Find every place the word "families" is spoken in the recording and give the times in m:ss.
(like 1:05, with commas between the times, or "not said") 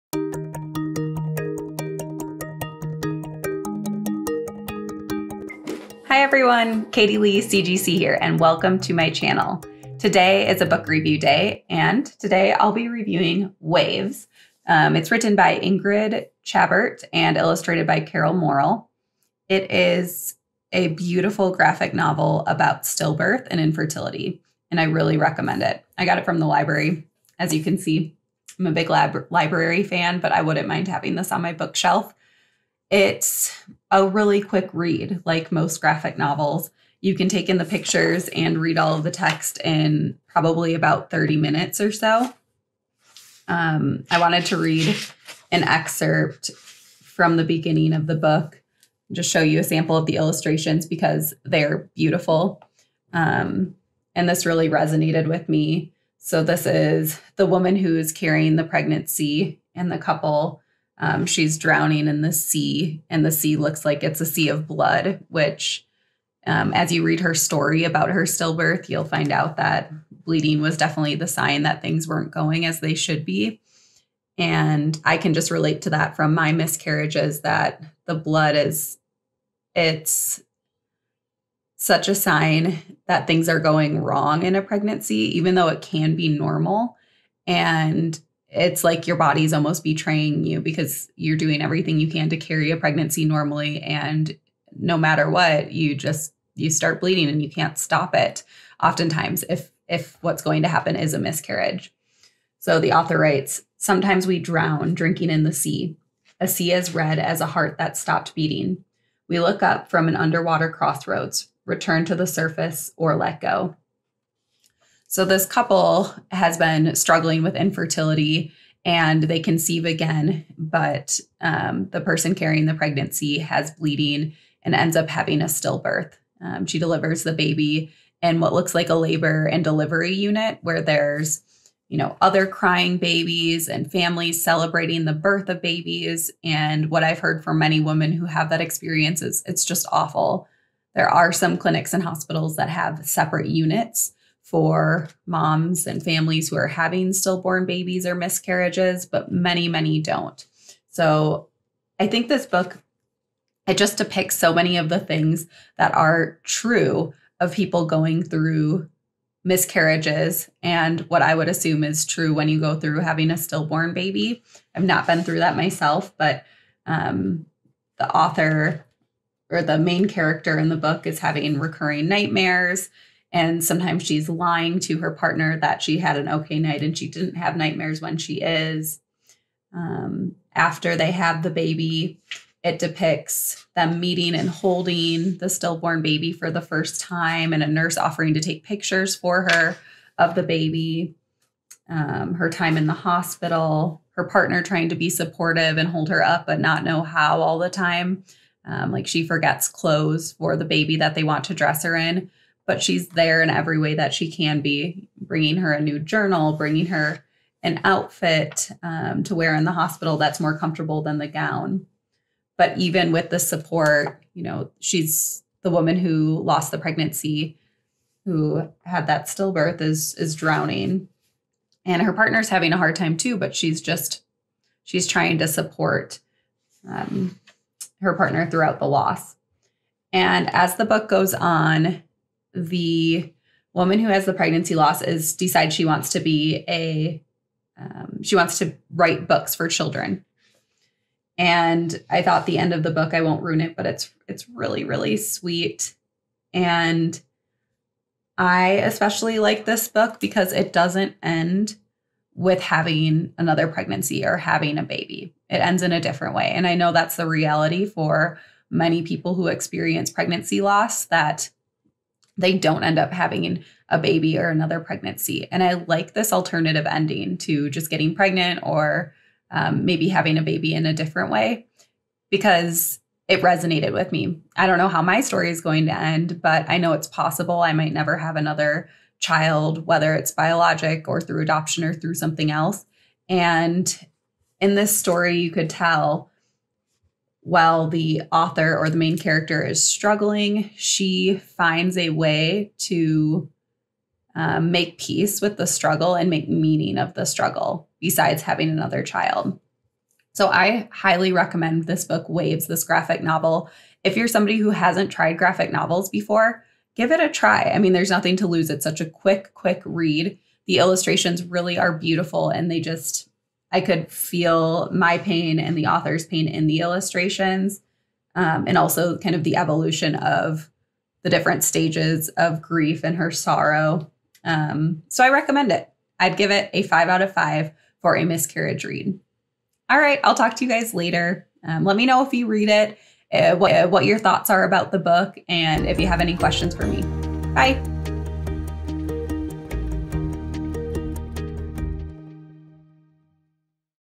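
2:13, 2:26.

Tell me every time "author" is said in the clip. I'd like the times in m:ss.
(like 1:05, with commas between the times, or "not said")
1:42, 2:48, 4:48, 5:15.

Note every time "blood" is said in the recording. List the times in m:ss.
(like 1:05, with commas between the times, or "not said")
1:04, 1:18.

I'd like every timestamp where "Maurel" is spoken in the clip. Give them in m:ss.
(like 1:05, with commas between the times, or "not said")
0:18.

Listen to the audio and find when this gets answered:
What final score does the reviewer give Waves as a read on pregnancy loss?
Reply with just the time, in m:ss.
5:26.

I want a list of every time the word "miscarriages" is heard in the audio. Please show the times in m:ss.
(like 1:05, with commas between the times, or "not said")
1:16, 1:41, 2:28, 2:39, 5:28.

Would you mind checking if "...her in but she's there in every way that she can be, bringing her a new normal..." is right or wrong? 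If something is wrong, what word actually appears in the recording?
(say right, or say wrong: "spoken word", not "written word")
wrong: "journal", not "normal".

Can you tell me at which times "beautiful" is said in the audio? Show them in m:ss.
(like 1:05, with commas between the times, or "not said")
0:20, 0:51, 5:11.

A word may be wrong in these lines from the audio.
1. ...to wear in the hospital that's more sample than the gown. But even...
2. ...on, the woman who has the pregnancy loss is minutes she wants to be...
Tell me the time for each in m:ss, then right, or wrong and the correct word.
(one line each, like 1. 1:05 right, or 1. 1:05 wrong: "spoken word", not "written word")
1. 3:29 wrong: "comfortable", not "sample"
2. 3:51 wrong: "decides", not "minutes".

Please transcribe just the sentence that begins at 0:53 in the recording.
Um, and this really resonated with me.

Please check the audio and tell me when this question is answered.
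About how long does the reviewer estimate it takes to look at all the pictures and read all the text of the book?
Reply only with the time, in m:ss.
0:41.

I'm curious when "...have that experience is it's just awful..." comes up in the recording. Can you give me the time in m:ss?
2:18.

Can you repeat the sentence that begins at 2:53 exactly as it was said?
And sometimes she's lying to her partner that she had an okay night and she didn't have nightmares when she is.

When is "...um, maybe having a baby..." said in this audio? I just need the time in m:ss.
4:29.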